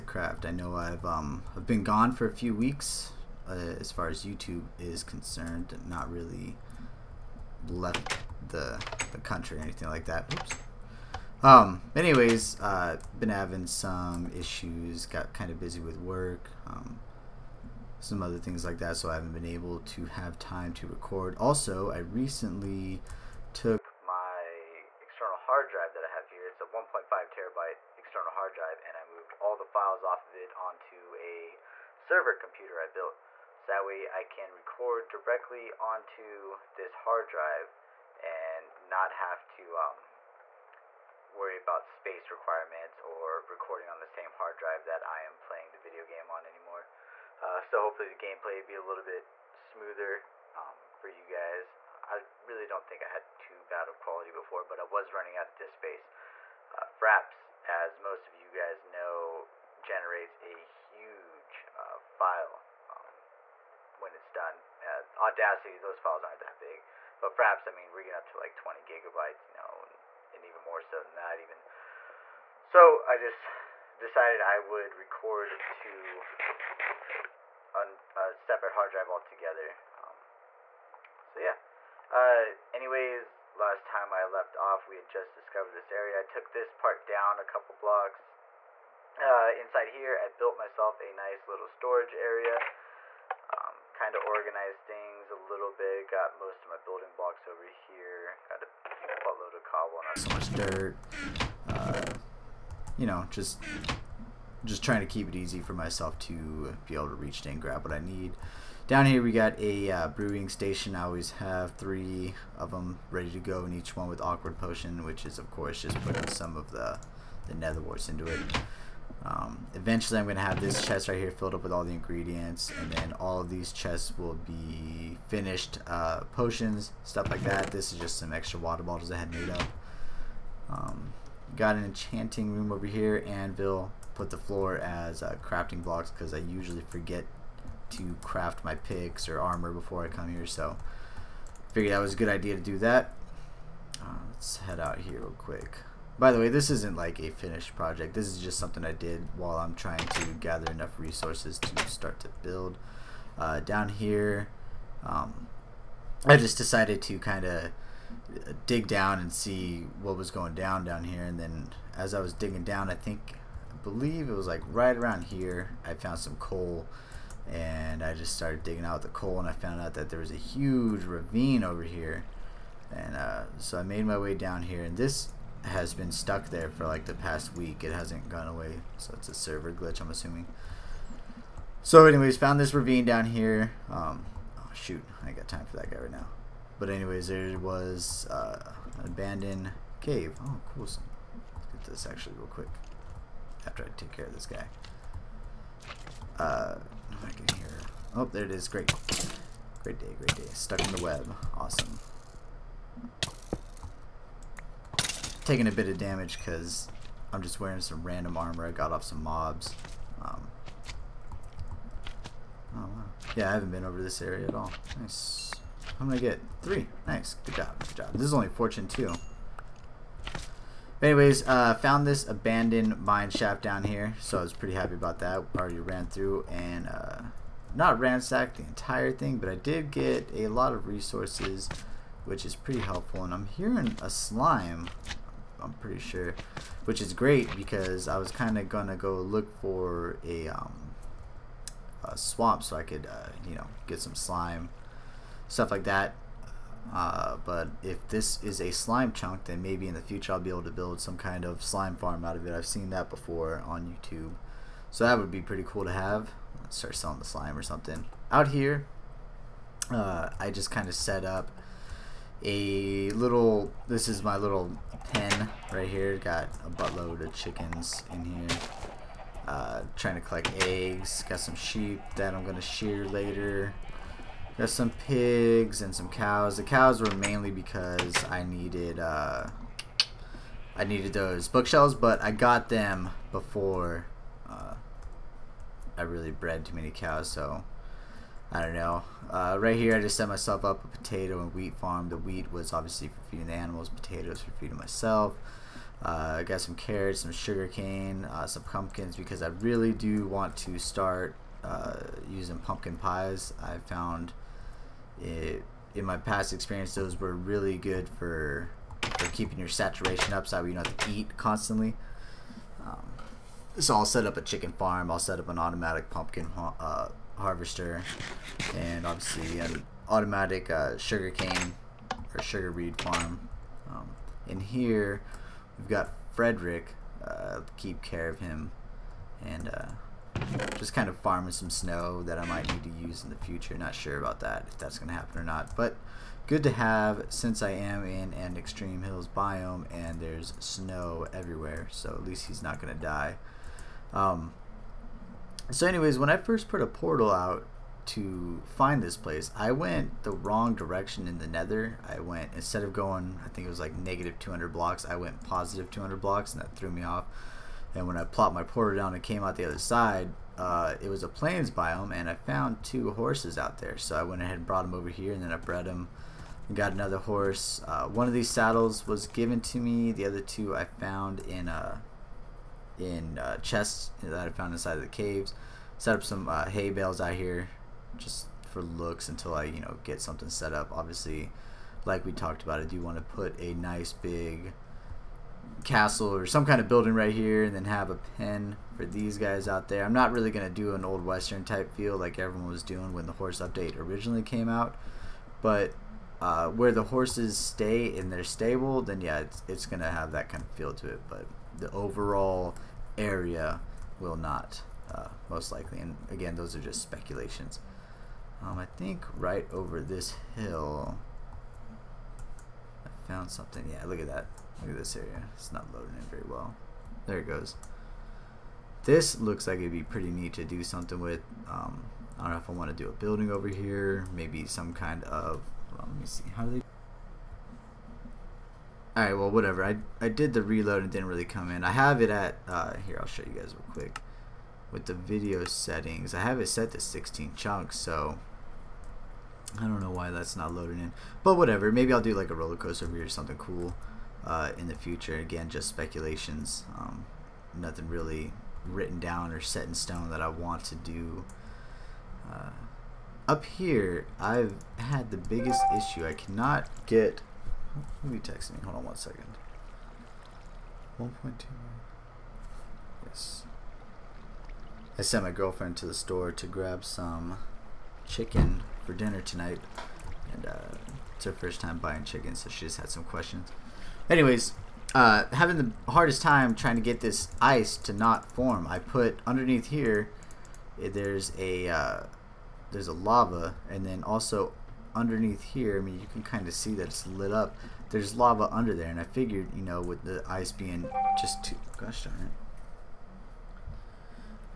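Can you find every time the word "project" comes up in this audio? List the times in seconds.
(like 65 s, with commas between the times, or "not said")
147 s.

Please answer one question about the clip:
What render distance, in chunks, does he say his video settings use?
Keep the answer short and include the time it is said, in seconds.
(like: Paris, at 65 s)
16, at 436 s.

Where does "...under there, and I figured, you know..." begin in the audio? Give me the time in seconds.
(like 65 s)
488 s.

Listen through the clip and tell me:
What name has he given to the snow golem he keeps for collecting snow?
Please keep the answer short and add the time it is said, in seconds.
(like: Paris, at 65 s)
Frederick, at 326 s.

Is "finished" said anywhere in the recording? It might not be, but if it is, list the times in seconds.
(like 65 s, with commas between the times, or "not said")
125 s, 147 s.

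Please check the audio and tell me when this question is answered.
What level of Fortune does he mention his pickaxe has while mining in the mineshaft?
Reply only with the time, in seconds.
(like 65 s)
218 s.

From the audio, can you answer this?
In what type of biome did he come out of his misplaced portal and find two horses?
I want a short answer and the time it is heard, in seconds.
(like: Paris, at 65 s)
Plains, at 361 s.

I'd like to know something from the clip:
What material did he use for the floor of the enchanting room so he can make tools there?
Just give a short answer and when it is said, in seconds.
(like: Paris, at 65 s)
Crafting blocks, at 135 s.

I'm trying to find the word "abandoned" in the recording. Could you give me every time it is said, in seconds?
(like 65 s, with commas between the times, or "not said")
189 s, 222 s.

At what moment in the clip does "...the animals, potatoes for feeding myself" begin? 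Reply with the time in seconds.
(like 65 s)
293 s.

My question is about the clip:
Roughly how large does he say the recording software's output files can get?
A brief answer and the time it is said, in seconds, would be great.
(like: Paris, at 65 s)
20 gigabytes, at 68 s.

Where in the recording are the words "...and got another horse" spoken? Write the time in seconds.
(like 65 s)
366 s.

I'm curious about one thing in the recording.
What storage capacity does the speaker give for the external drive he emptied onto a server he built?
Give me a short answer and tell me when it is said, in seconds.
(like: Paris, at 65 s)
1.5 terabytes, at 26 s.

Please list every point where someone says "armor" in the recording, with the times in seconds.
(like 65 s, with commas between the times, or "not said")
139 s, 208 s.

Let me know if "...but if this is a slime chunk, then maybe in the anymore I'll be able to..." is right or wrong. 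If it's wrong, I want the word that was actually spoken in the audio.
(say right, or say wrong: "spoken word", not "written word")
wrong: "future", not "anymore".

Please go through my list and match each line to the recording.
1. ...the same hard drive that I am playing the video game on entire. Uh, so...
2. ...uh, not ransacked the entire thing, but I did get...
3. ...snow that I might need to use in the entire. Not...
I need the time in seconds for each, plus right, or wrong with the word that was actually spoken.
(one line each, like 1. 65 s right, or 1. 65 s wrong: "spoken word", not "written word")
1. 44 s wrong: "anymore", not "entire"
2. 226 s right
3. 331 s wrong: "future", not "entire".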